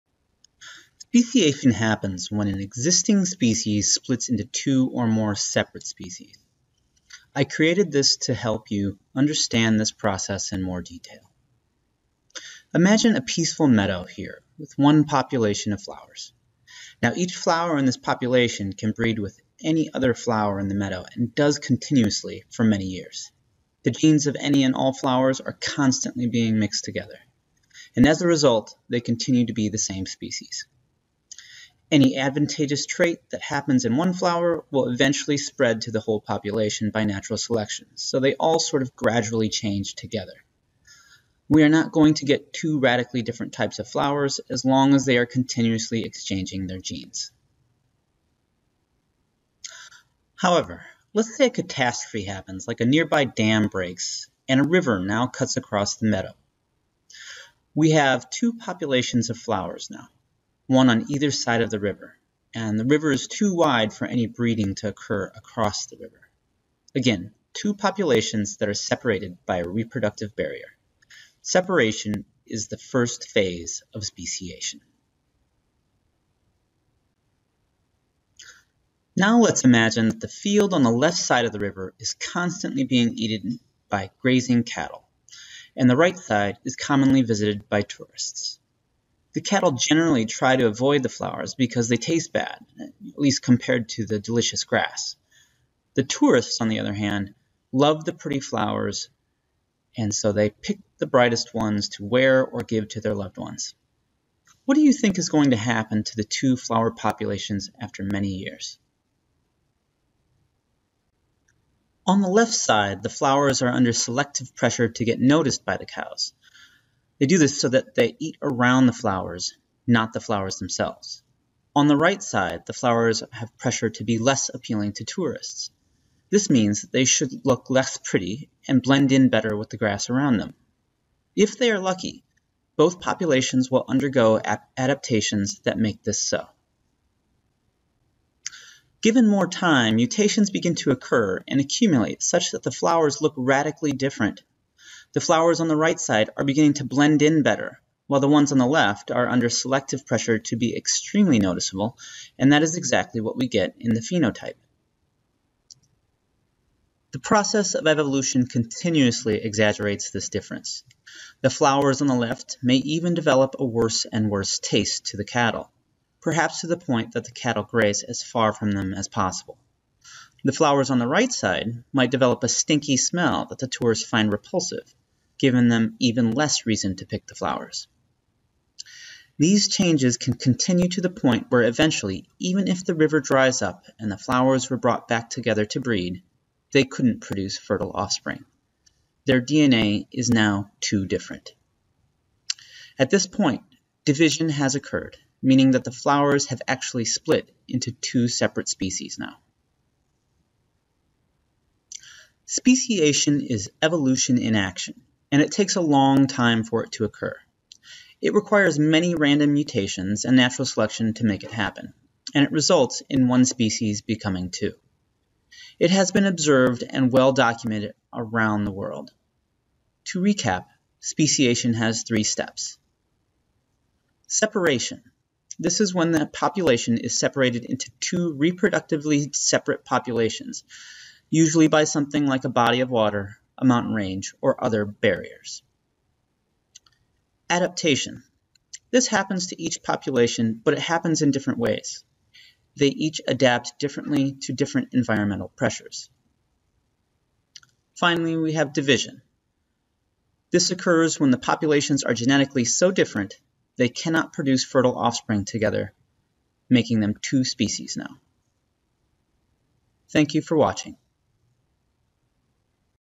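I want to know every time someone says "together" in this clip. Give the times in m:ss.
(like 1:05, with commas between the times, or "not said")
0:26, 0:39, 3:05, 4:15.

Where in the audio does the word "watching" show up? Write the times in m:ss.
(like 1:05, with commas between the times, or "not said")
4:20.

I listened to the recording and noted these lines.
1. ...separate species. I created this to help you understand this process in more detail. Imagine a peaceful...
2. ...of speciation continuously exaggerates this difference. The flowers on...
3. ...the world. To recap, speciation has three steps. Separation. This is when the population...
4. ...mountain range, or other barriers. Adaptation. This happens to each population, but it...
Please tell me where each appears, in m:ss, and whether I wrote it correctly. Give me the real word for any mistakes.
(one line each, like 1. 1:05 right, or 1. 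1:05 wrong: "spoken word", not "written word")
1. 0:05 right
2. 2:37 wrong: "evolution", not "speciation"
3. 3:38 right
4. 3:53 right.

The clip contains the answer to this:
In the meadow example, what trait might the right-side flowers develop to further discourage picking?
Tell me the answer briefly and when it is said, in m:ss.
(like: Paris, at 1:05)
A stinky smell, at 2:52.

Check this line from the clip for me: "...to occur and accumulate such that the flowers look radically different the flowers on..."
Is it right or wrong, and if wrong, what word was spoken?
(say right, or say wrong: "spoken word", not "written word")
right.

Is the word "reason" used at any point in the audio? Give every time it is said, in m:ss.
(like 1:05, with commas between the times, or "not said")
2:56.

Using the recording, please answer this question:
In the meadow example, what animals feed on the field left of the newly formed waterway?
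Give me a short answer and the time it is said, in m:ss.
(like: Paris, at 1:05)
Grazing cattle, at 1:24.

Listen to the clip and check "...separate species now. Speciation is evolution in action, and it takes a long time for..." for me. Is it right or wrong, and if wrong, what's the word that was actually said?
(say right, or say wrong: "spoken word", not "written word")
right.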